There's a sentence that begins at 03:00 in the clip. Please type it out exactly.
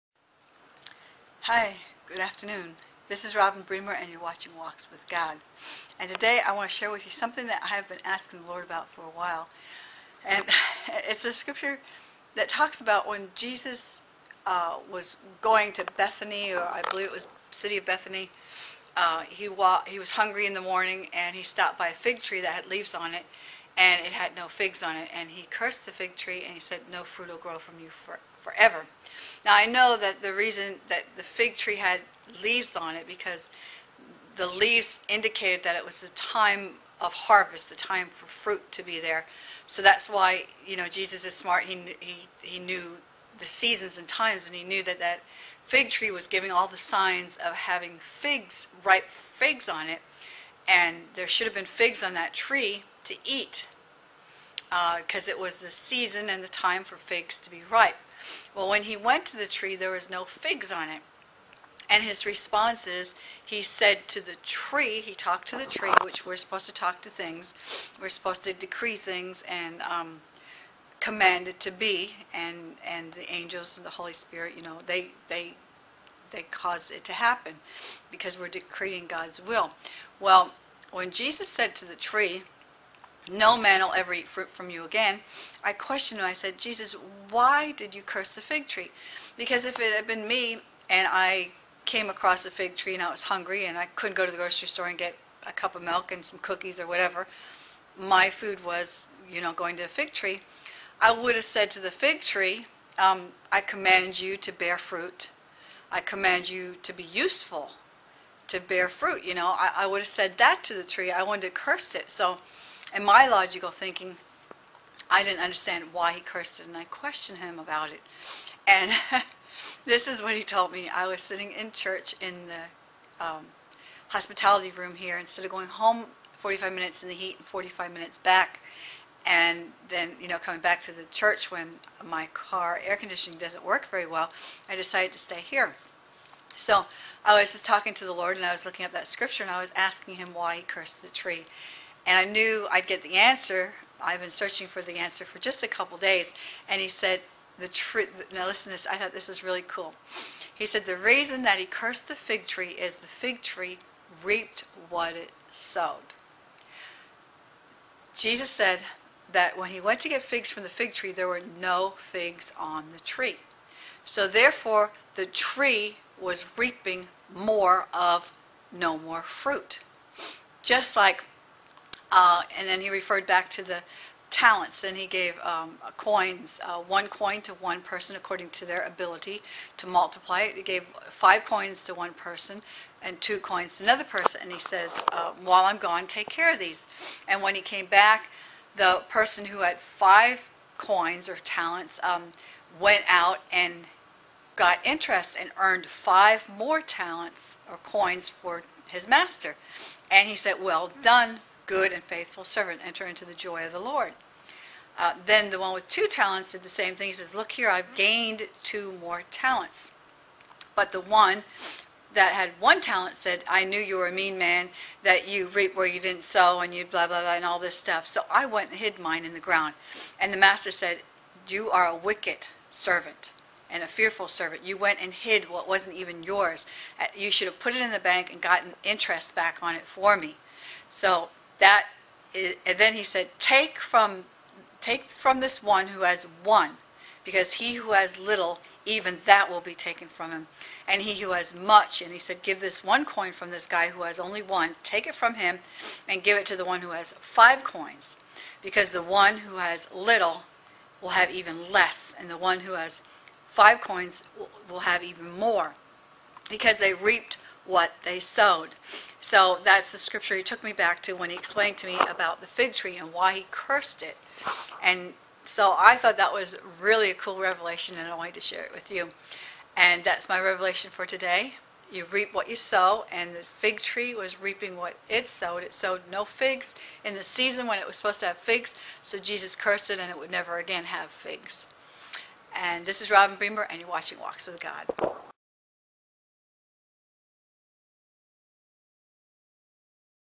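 He gave five coins to one person and two coins to another person.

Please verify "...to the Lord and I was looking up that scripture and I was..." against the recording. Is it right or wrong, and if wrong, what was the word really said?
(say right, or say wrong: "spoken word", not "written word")
right.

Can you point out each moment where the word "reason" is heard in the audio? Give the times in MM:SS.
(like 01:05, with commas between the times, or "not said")
00:30, 02:30.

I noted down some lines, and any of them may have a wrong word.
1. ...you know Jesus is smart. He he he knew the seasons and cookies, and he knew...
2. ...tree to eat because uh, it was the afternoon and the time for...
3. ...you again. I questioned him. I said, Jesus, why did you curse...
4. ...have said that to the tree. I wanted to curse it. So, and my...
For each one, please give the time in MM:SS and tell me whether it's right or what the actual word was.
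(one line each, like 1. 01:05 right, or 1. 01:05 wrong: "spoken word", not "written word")
1. 00:40 wrong: "times", not "cookies"
2. 00:52 wrong: "season", not "afternoon"
3. 01:24 right
4. 01:49 right.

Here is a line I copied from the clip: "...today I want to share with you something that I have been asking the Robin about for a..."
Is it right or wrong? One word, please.
wrong.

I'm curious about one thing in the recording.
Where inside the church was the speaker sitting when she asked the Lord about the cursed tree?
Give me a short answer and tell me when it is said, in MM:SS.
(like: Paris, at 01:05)
hospitality room, at 02:04.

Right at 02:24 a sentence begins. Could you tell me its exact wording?
I've been searching for the answer for just a couple days.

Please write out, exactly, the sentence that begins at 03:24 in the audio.
Uh, then the one with two talents did the same thing.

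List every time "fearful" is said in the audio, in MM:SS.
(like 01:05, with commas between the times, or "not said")
03:43.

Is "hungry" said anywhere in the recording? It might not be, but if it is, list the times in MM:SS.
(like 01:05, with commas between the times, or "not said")
00:20, 01:33.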